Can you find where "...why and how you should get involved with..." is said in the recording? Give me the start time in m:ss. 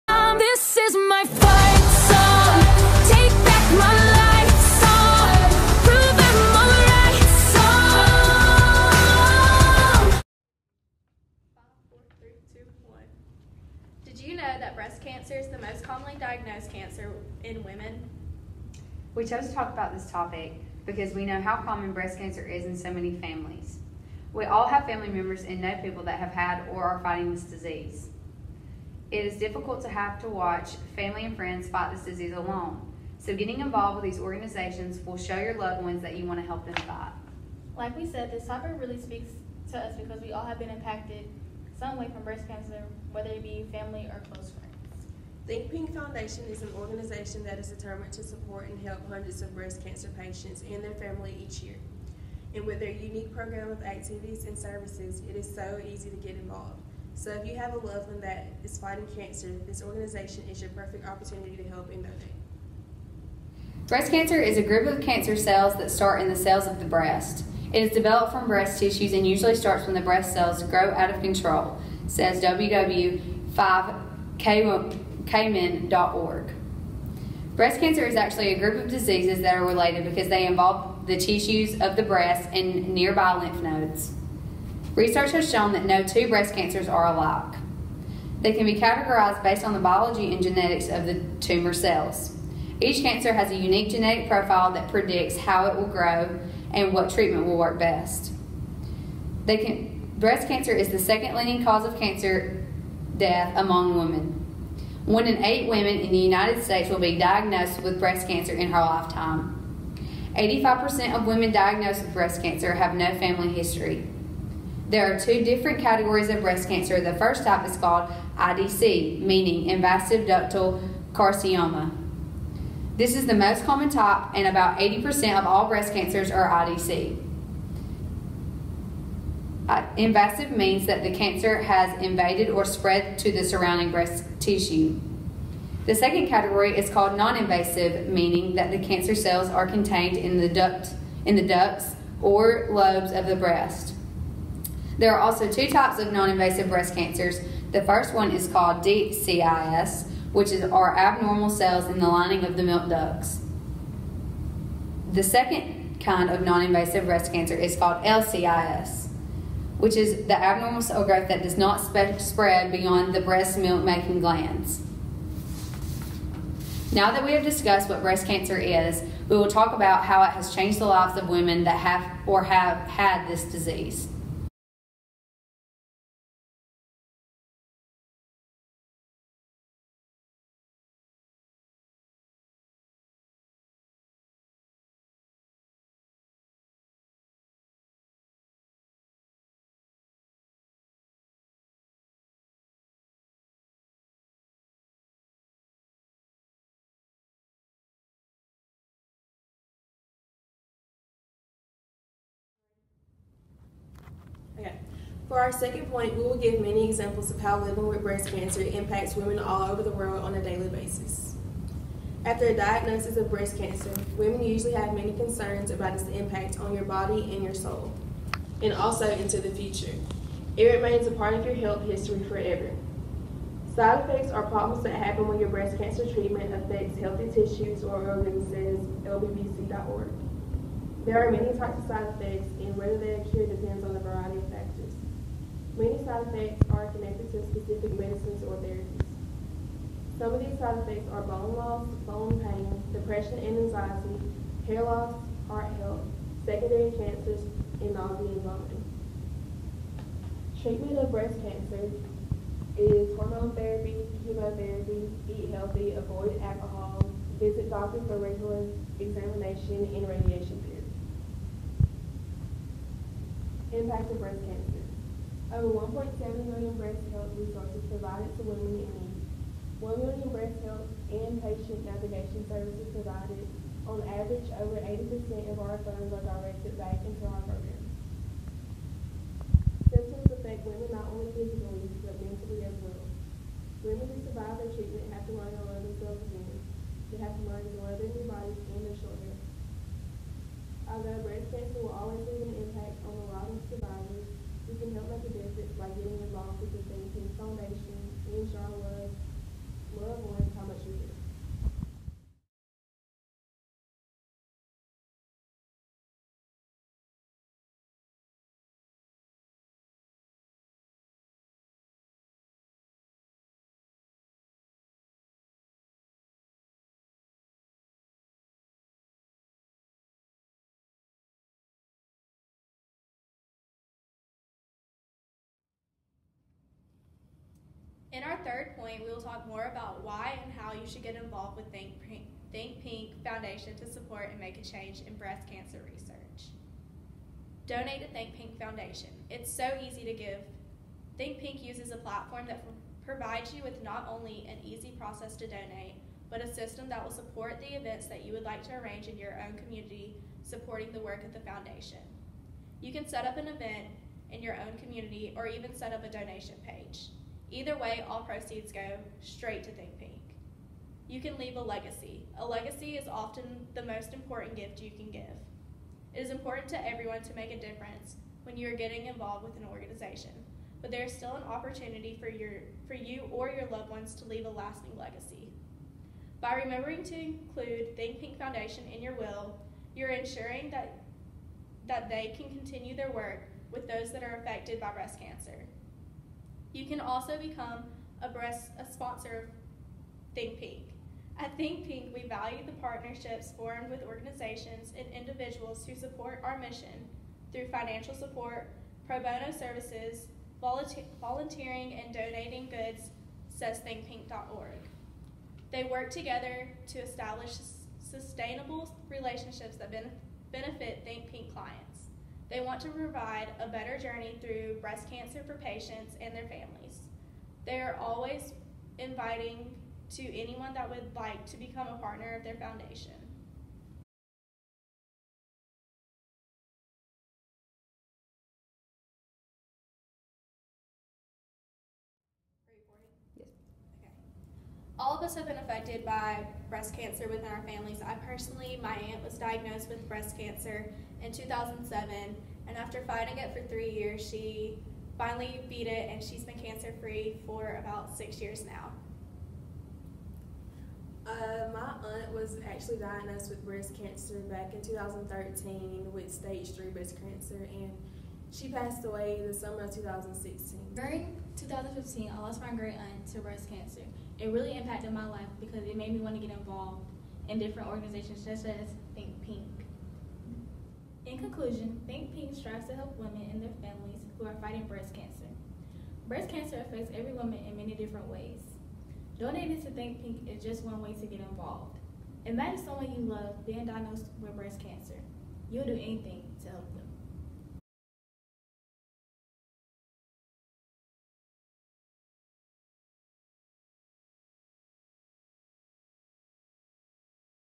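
5:30.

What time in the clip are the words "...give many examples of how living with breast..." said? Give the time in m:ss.
3:26.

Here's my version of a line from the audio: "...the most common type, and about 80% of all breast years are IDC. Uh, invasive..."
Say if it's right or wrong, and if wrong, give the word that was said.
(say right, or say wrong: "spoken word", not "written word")
wrong: "cancers", not "years".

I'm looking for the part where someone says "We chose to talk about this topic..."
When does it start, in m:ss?
0:19.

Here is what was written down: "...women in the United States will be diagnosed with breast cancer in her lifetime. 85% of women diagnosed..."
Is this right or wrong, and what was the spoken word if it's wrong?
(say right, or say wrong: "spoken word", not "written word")
right.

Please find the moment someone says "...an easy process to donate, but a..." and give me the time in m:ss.
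5:44.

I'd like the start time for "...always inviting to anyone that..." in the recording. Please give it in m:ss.
6:57.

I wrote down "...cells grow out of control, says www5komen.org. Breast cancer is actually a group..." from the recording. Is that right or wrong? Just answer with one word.
right.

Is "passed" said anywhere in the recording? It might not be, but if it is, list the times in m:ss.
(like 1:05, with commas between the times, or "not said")
7:38.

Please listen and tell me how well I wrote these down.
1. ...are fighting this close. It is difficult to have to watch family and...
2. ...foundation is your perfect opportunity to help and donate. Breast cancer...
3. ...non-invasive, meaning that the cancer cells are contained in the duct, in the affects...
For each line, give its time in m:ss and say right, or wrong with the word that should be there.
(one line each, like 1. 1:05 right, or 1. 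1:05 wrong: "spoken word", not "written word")
1. 0:26 wrong: "disease", not "close"
2. 0:59 wrong: "organization", not "foundation"
3. 2:17 wrong: "ducts", not "affects".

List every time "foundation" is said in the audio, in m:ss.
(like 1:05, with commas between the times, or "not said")
0:45, 5:33, 5:38, 5:51, 6:18, 7:02.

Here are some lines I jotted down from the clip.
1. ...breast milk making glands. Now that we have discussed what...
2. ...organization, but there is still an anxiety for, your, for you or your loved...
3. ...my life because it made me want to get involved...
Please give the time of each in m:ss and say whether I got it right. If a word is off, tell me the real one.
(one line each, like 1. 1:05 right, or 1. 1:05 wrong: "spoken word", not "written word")
1. 2:43 right
2. 6:09 wrong: "opportunity", not "anxiety"
3. 7:45 right.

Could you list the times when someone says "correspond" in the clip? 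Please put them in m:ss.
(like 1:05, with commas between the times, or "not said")
not said.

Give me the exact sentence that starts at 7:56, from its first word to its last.
Breast cancer affects every woman in many different ways.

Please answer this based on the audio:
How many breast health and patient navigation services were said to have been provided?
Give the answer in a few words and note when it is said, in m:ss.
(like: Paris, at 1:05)
1 million, at 4:29.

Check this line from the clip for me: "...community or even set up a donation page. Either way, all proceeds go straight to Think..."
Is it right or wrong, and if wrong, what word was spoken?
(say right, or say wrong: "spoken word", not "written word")
right.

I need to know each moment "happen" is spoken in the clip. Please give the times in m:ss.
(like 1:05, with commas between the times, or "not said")
3:44.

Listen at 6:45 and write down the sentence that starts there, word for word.
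They work together to establish sustainable relationships that benefit Think Pink clients.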